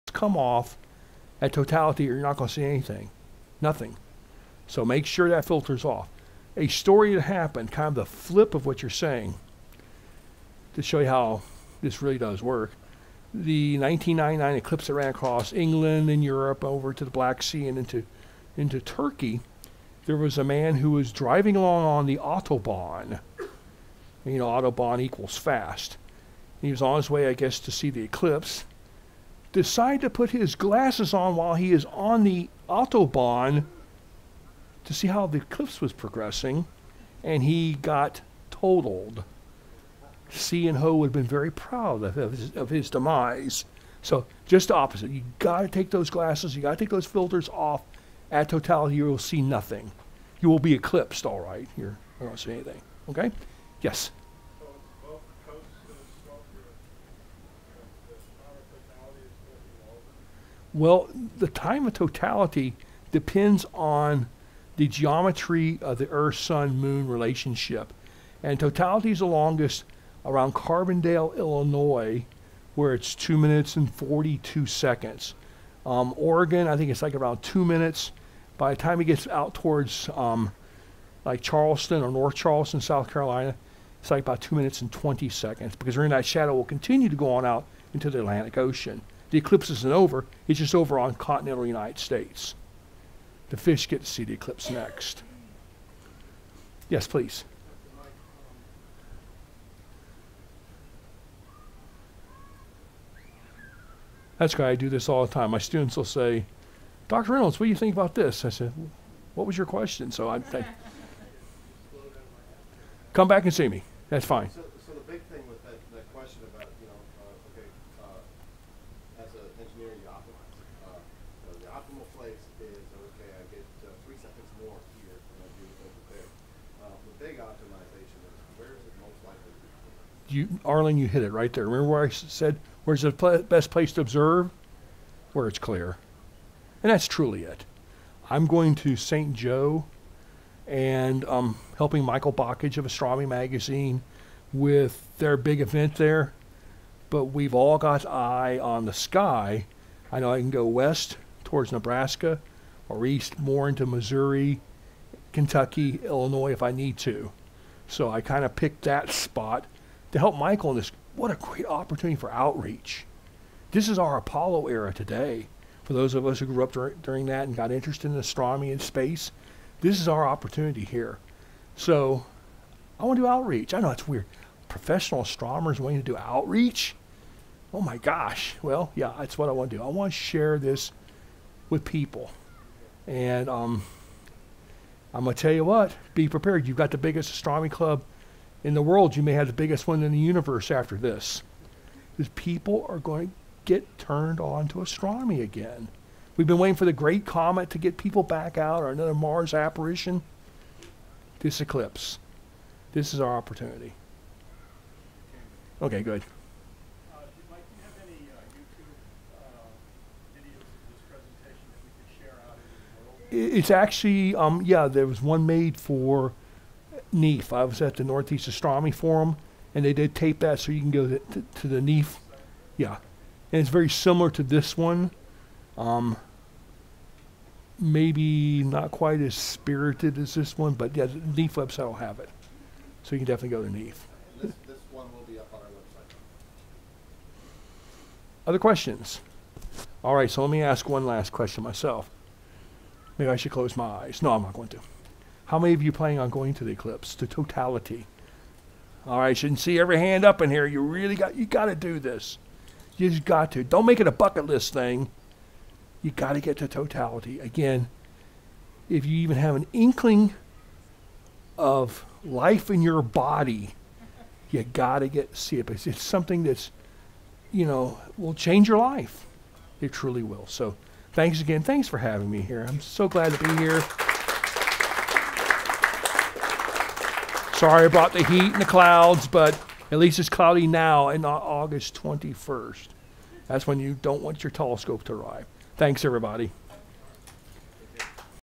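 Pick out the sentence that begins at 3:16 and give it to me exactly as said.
We've been waiting for the great comet to get people back out or another Mars apparition.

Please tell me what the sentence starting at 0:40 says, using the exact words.
C and Ho would have been very proud of his, of his demise.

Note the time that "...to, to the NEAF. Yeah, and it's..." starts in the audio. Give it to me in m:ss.
3:41.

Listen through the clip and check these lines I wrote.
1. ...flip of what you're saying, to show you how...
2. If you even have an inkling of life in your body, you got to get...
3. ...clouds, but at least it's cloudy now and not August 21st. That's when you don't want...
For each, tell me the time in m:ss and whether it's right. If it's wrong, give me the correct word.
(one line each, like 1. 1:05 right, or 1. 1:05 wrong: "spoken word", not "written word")
1. 0:08 right
2. 4:18 right
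3. 4:38 right.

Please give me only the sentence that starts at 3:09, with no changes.
You may have the biggest one in the universe after this.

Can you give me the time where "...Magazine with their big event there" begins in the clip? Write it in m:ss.
2:23.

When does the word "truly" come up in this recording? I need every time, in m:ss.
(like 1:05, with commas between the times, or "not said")
2:17, 4:29.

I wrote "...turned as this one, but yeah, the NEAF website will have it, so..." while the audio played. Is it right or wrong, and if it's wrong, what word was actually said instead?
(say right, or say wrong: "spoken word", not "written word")
wrong: "spirited", not "turned".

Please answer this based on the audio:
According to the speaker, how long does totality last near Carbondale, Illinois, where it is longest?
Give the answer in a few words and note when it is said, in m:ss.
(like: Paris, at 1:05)
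2 minutes and 42 seconds, at 1:13.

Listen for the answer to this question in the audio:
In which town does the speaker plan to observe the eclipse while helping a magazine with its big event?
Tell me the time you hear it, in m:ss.
2:18.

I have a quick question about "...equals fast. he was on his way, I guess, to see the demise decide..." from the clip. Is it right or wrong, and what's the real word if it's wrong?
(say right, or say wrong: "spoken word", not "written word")
wrong: "eclipse", not "demise".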